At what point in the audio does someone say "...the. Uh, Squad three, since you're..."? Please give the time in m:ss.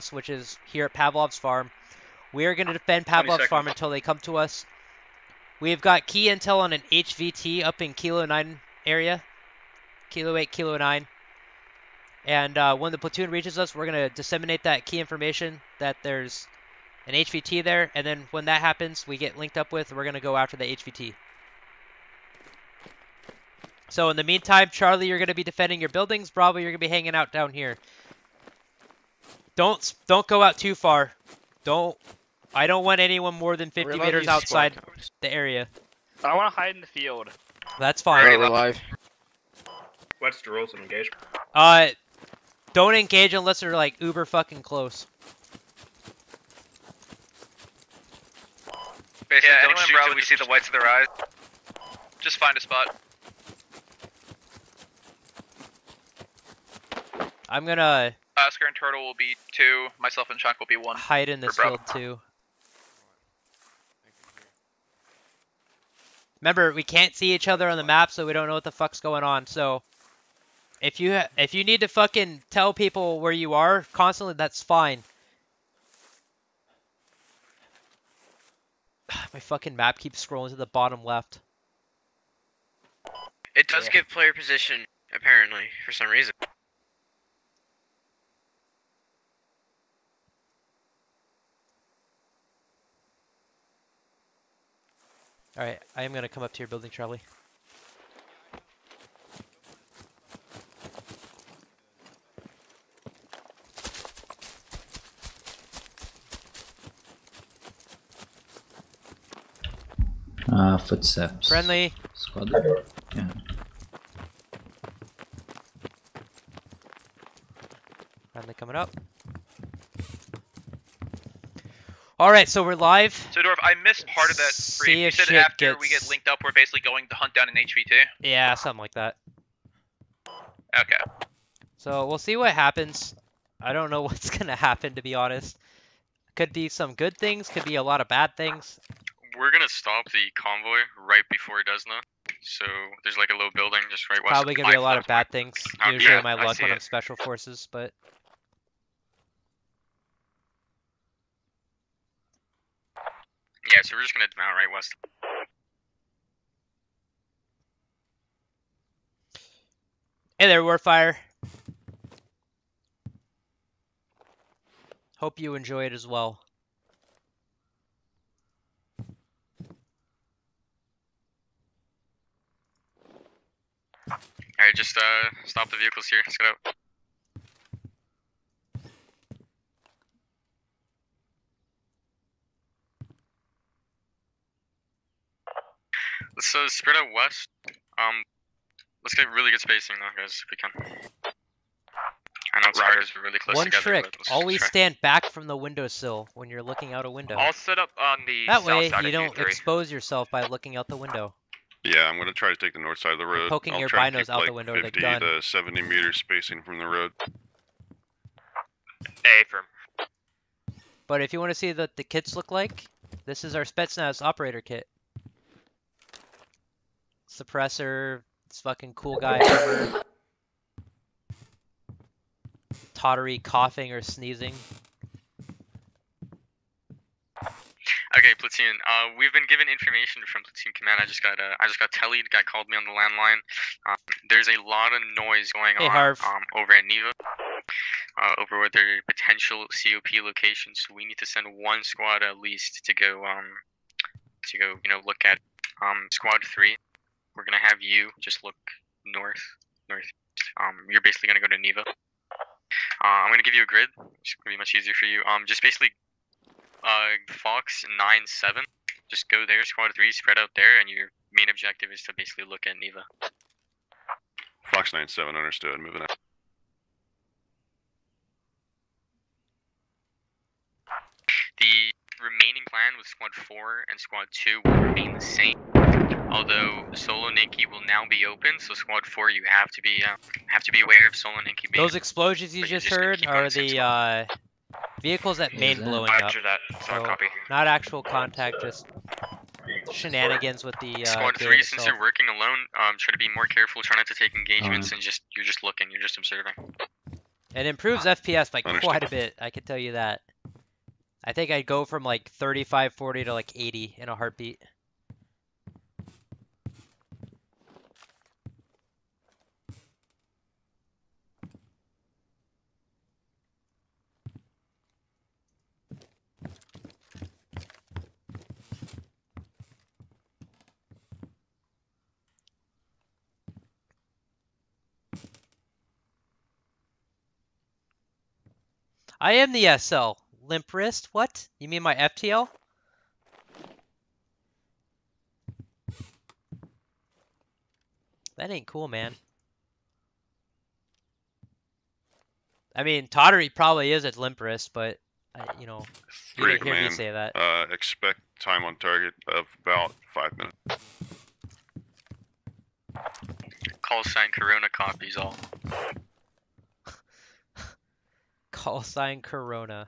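4:50.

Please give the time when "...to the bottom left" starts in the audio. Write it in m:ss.
1:20.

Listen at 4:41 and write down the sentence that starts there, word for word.
Those explosions you just, just heard are the uh, Vehicles that main yeah, blowing up.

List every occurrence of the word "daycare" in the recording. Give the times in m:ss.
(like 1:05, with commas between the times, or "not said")
not said.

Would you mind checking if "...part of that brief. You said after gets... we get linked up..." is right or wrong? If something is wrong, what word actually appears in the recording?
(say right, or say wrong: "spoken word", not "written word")
right.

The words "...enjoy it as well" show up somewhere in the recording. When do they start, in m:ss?
2:45.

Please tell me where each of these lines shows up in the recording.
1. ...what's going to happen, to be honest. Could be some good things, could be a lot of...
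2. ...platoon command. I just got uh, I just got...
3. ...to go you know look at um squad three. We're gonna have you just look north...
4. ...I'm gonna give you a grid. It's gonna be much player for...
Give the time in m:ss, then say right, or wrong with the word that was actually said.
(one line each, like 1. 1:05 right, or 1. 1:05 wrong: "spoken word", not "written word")
1. 2:14 right
2. 3:50 right
3. 4:04 right
4. 4:13 wrong: "easier", not "player".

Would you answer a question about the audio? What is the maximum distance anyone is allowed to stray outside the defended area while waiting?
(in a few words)
50 meters.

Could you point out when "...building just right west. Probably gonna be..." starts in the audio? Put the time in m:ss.
2:23.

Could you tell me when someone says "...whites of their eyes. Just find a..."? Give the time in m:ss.
0:50.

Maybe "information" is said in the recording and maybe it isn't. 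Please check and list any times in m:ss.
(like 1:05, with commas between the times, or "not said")
0:15, 3:49.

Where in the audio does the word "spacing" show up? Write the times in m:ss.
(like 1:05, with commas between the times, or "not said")
3:09, 3:26.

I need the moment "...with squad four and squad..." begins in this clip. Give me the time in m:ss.
4:32.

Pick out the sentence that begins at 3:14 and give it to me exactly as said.
stand back from the windowsill when you're looking out a window.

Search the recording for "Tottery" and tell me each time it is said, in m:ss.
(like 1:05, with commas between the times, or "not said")
3:42, 5:43.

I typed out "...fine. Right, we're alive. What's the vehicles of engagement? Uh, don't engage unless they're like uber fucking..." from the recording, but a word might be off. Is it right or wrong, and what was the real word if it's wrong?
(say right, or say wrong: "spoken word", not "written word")
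wrong: "rules", not "vehicles".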